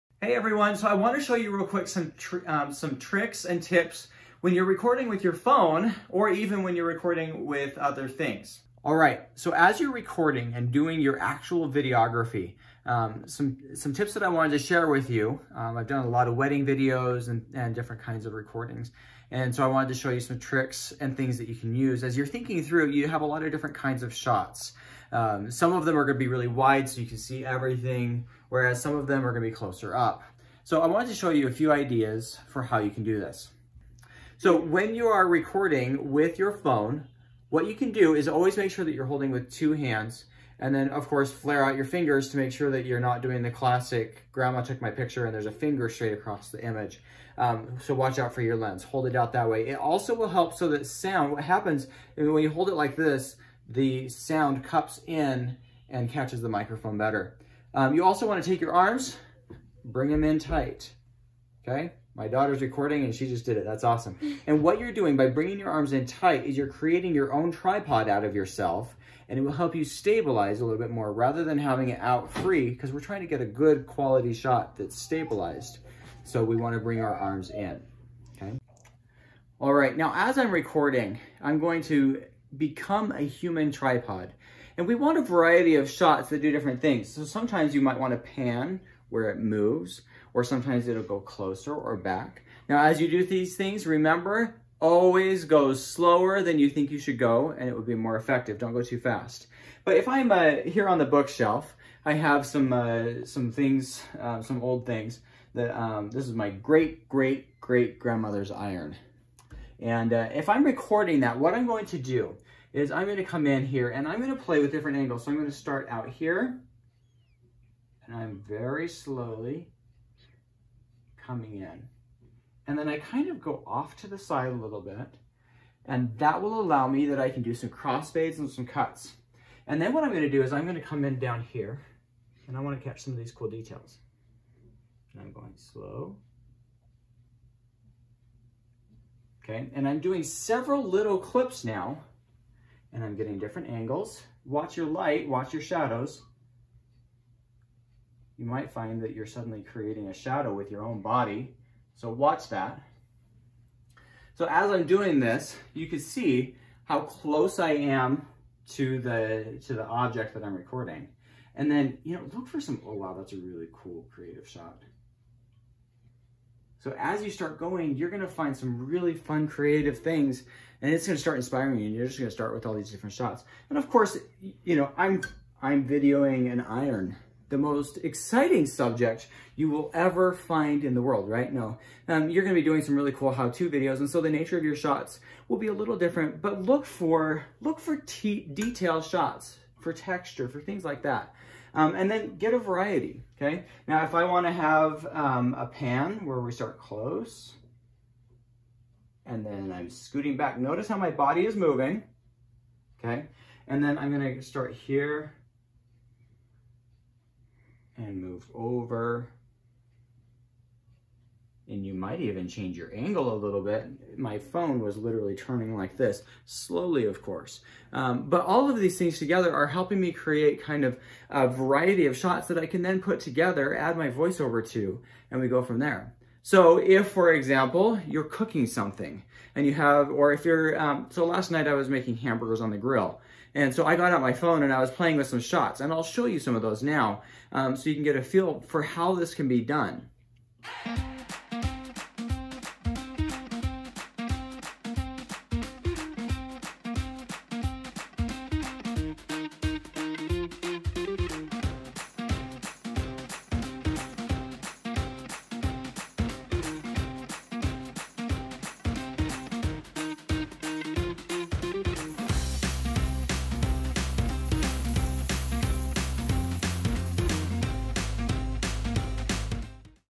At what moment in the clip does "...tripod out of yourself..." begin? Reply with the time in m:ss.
1:07.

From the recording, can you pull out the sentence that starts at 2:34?
So as I'm doing this, you can see how close I am to the, to the object that I'm recording.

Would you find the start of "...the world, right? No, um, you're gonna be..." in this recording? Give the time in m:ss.
3:00.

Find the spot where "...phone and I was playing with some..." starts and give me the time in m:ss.
3:54.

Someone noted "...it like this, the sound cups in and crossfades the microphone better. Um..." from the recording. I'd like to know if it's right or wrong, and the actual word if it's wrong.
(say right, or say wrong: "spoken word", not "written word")
wrong: "catches", not "crossfades".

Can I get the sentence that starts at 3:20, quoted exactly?
Notice how my body is moving, okay?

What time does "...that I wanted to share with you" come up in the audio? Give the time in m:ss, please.
0:14.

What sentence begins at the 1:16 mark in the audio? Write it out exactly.
So we want to bring our arms in, okay?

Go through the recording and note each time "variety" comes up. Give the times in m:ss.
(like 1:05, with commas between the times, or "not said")
1:25, 3:12, 3:41.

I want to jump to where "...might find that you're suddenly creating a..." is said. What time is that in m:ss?
2:28.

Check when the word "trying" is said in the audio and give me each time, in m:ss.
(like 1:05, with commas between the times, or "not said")
1:12.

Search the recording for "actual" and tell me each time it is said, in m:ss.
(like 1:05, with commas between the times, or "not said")
0:11.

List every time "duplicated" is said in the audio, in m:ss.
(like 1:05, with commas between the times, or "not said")
not said.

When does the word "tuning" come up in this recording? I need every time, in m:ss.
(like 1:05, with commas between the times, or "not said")
not said.